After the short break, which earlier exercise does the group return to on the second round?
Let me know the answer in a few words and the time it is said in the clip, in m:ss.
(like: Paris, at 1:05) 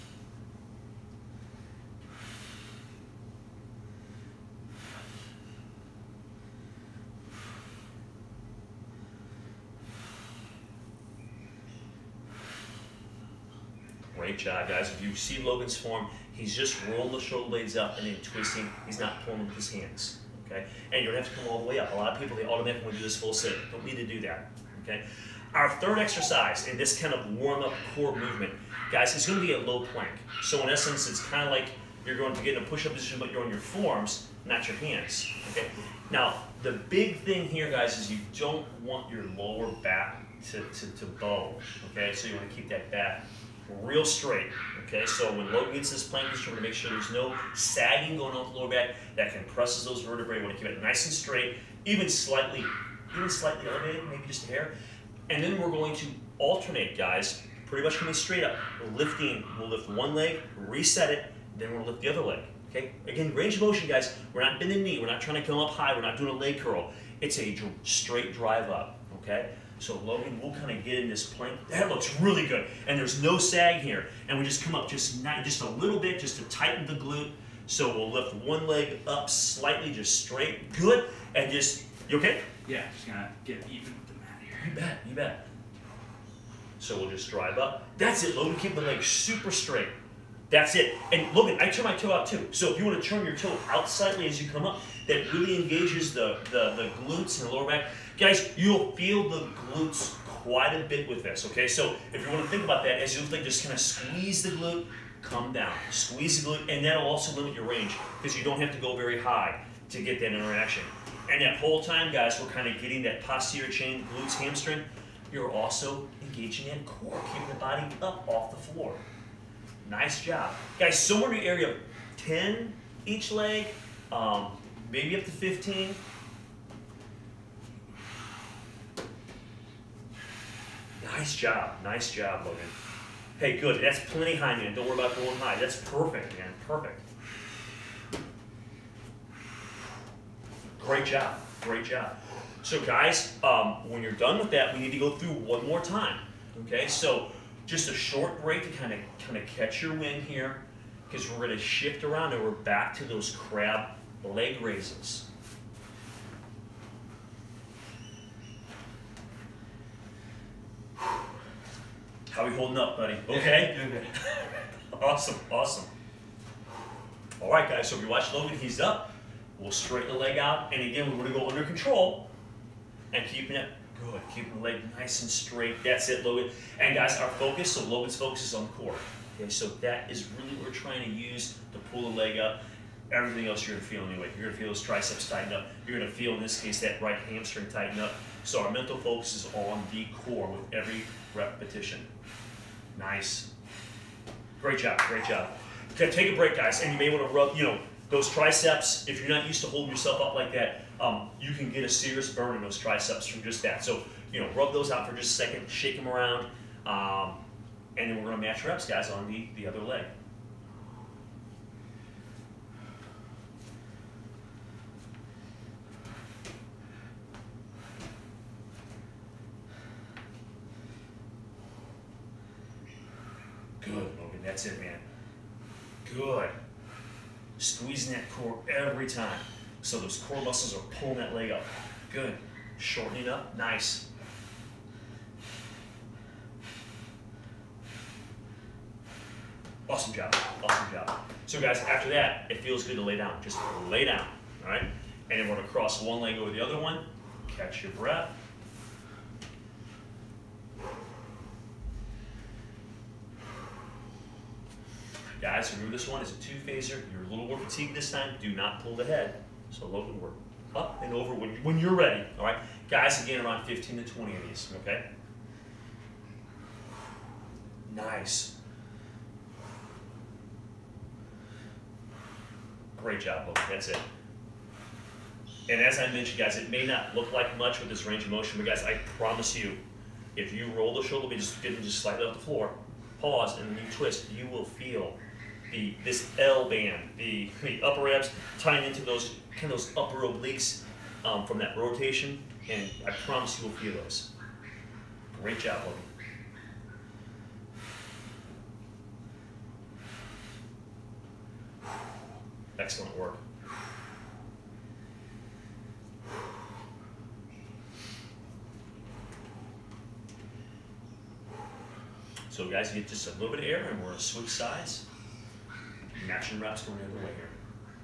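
crab leg raises, at 2:33.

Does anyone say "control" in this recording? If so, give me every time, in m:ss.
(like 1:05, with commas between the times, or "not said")
2:51.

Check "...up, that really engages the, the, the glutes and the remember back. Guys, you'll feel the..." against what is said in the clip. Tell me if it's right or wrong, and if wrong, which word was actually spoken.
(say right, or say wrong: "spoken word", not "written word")
wrong: "lower", not "remember".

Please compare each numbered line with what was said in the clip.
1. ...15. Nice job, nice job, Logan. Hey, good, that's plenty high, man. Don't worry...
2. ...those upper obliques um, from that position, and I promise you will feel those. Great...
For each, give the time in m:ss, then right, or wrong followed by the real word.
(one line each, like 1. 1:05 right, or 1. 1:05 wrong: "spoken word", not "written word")
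1. 2:05 right
2. 4:49 wrong: "rotation", not "position".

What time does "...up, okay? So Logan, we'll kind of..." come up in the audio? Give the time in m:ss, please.
1:08.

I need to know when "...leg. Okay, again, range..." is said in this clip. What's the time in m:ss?
1:02.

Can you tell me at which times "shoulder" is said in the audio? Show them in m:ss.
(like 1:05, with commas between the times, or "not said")
0:17, 4:41.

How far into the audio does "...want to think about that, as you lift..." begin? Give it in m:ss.
1:42.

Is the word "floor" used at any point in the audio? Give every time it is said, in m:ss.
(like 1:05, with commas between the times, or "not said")
1:58, 4:42.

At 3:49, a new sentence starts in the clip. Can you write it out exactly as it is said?
So those core muscles are pulling that leg up.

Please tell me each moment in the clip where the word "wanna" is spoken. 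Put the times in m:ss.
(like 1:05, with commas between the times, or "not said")
0:42, 0:50, 3:17.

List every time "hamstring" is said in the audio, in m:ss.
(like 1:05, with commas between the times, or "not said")
1:54, 3:07.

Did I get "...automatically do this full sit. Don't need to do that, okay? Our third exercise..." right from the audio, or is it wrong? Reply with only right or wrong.
right.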